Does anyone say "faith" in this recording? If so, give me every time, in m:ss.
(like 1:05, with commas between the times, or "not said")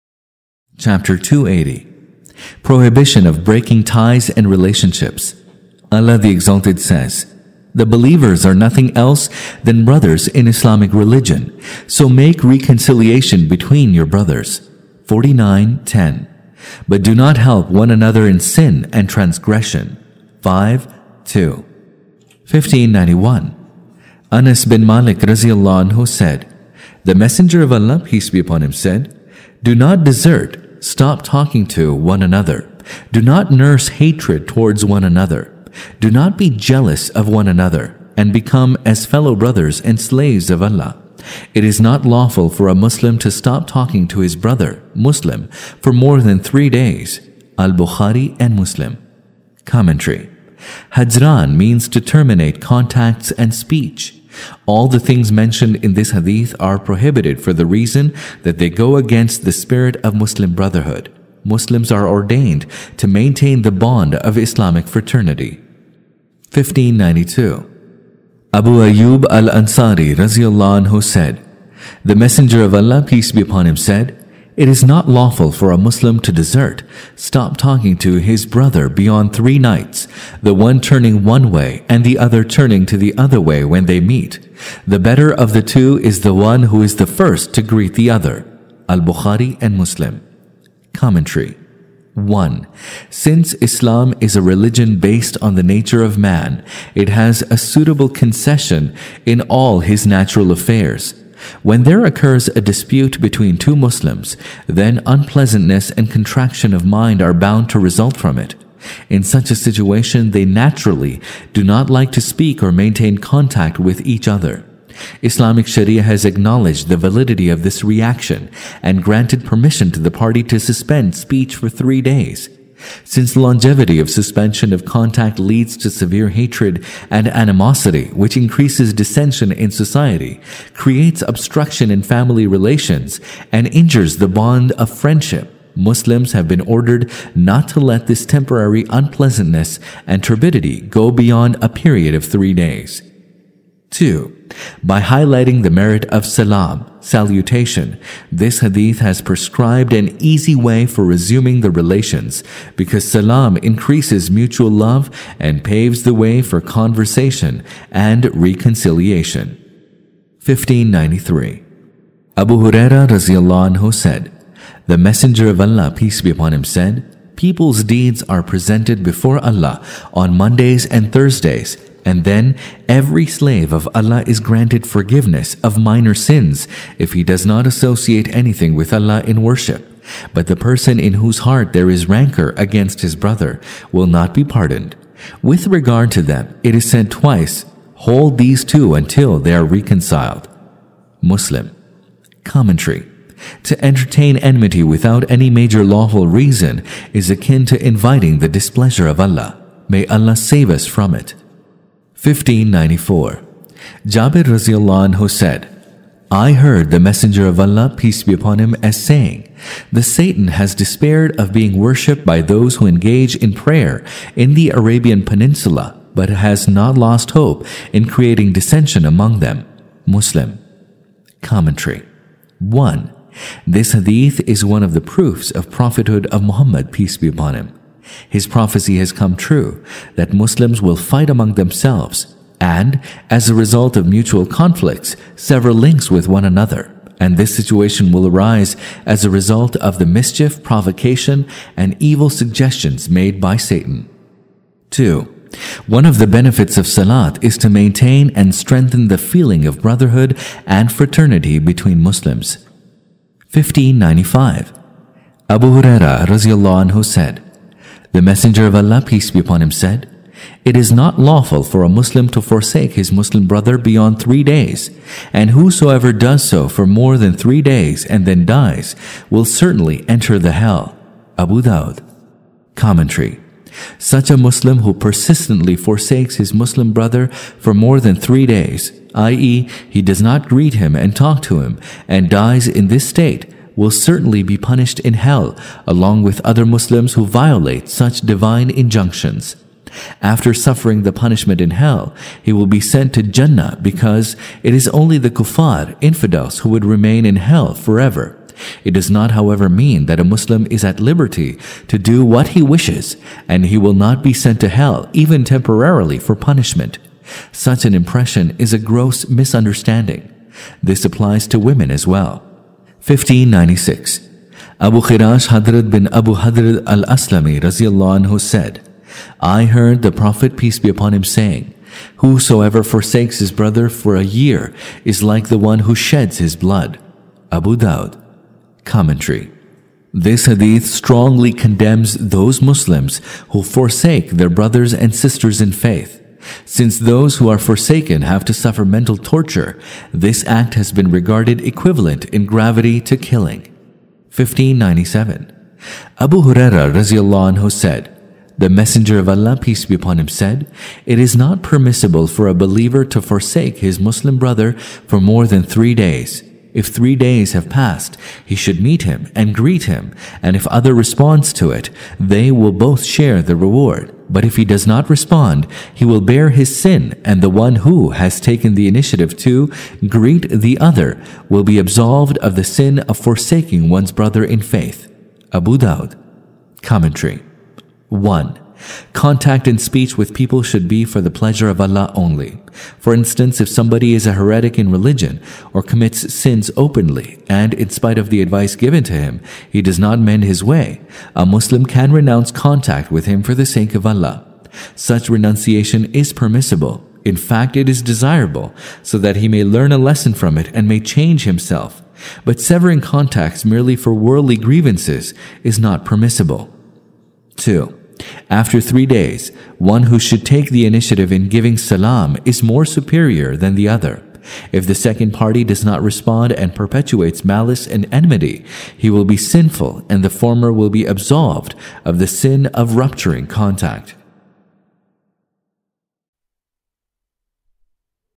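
5:35, 6:14.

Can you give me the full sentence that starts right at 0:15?
49.10 But do not help one another in sin and transgression.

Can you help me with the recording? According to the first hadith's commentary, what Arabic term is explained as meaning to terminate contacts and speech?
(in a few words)
Hajran.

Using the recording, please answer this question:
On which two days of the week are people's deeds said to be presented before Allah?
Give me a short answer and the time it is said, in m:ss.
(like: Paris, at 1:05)
Mondays and Thursdays, at 2:50.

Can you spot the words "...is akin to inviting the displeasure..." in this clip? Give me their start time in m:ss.
3:17.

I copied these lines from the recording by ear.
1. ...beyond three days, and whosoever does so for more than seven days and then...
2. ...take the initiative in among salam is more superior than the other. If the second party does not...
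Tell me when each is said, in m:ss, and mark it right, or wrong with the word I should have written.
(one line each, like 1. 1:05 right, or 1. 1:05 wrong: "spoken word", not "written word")
1. 4:23 wrong: "three", not "seven"
2. 6:50 wrong: "giving", not "among".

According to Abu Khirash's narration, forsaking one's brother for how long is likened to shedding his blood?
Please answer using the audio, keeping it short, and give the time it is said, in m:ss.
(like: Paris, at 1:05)
a year, at 5:24.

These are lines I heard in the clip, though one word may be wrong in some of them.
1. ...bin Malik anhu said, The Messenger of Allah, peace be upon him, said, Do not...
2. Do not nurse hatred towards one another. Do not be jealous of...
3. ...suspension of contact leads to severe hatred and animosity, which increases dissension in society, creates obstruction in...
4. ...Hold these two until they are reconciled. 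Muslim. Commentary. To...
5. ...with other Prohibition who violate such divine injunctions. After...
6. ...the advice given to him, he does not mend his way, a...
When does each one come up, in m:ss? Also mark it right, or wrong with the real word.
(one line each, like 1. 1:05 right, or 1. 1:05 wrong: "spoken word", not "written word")
1. 0:24 right
2. 0:33 right
3. 2:04 right
4. 3:07 right
5. 4:46 wrong: "Muslims", not "Prohibition"
6. 6:28 right.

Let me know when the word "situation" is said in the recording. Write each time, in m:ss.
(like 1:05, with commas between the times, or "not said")
1:49, 3:57.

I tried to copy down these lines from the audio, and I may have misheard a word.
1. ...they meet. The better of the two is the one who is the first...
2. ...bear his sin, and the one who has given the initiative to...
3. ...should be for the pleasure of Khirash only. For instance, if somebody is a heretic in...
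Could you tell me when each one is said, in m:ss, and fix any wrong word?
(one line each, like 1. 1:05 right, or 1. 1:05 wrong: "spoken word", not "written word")
1. 1:23 right
2. 6:06 wrong: "taken", not "given"
3. 6:20 wrong: "Allah", not "Khirash".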